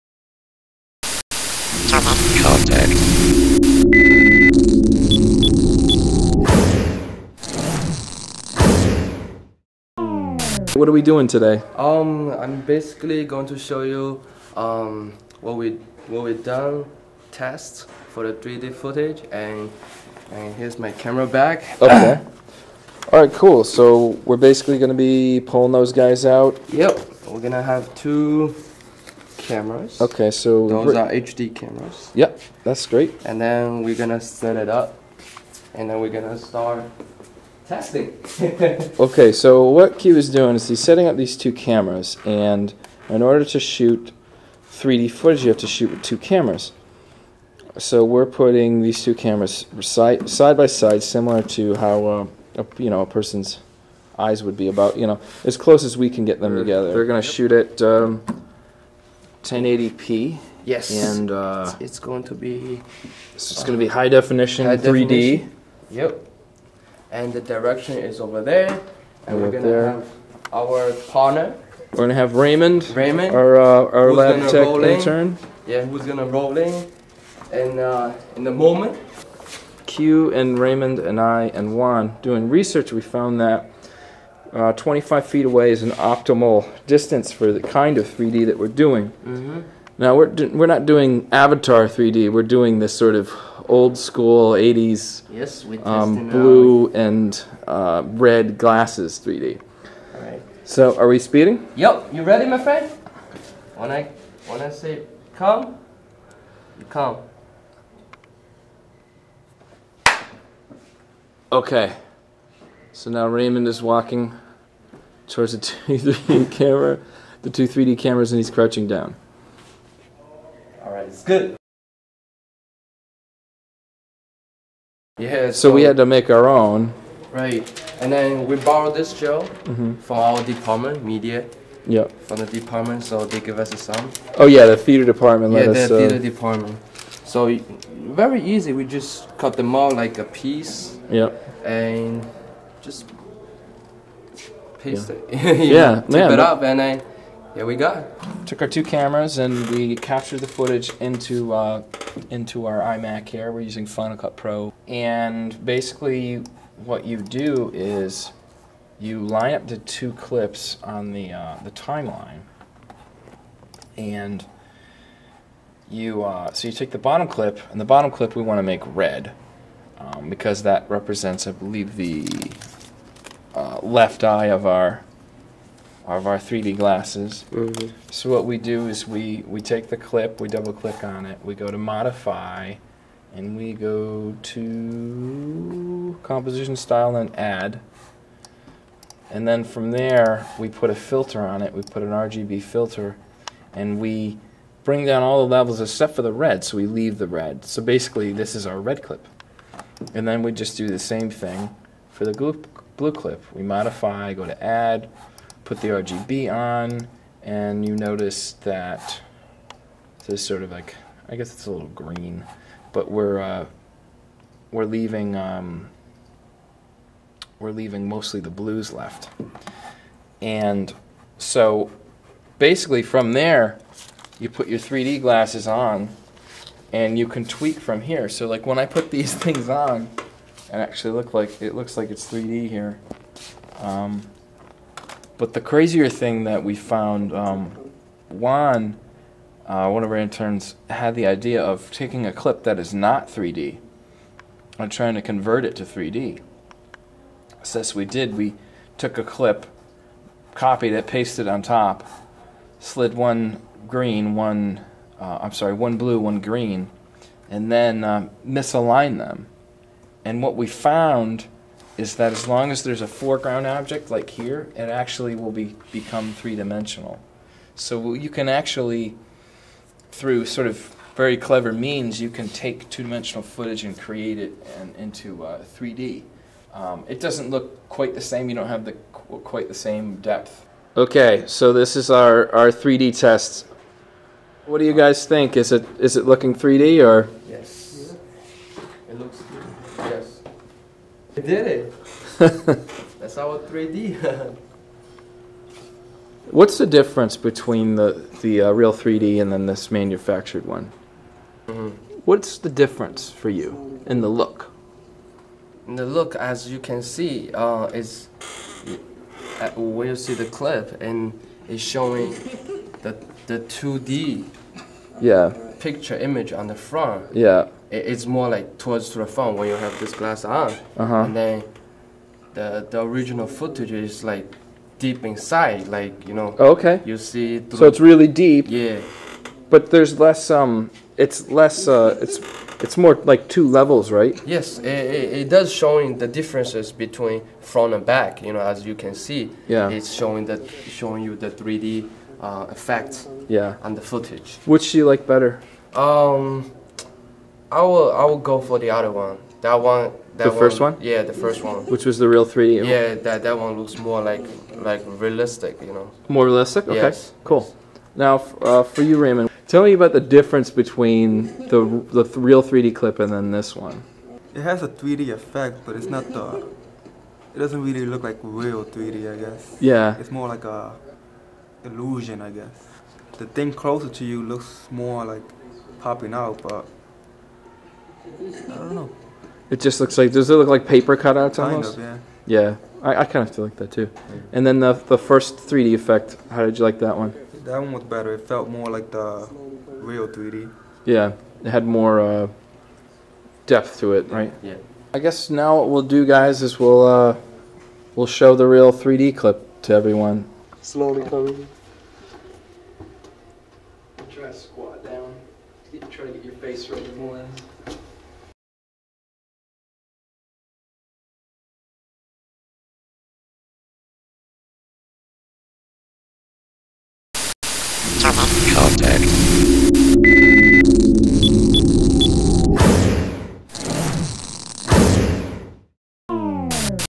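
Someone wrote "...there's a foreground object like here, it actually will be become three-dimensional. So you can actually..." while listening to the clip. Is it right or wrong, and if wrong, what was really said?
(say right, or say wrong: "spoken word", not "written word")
right.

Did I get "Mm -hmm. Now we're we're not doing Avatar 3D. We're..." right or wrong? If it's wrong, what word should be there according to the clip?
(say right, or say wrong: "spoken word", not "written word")
right.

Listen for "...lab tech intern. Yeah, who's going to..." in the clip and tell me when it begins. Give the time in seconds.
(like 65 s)
74 s.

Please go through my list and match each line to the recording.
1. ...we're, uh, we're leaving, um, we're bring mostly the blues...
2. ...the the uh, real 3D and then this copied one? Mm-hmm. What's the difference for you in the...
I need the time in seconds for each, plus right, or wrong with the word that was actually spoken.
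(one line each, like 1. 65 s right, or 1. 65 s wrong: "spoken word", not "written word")
1. 213 s wrong: "leaving", not "bring"
2. 297 s wrong: "manufactured", not "copied".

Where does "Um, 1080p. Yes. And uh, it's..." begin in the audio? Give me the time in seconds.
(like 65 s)
57 s.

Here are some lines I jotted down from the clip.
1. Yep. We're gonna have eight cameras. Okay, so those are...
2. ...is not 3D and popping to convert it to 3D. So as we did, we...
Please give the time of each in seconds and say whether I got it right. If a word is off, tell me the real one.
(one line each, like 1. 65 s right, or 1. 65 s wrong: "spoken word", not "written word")
1. 26 s wrong: "two", not "eight"
2. 242 s wrong: "trying", not "popping".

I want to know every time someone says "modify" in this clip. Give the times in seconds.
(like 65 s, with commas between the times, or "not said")
181 s, 203 s.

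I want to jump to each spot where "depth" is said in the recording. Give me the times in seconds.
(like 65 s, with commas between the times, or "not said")
280 s, 393 s.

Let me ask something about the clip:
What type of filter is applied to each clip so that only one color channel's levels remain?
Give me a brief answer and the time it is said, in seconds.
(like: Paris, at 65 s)
RGB filter, at 192 s.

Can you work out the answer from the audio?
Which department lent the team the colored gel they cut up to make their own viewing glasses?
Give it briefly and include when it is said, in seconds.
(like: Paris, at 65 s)
theater department, at 135 s.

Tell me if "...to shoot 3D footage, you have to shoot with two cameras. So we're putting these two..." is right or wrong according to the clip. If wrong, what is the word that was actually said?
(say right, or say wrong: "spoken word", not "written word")
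right.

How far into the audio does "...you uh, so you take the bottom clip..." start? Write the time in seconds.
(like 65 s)
165 s.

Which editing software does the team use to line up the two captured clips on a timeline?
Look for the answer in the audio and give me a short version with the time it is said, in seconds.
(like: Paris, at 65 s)
Final Cut Pro, at 153 s.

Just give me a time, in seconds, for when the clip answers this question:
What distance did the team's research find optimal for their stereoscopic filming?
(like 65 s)
84 s.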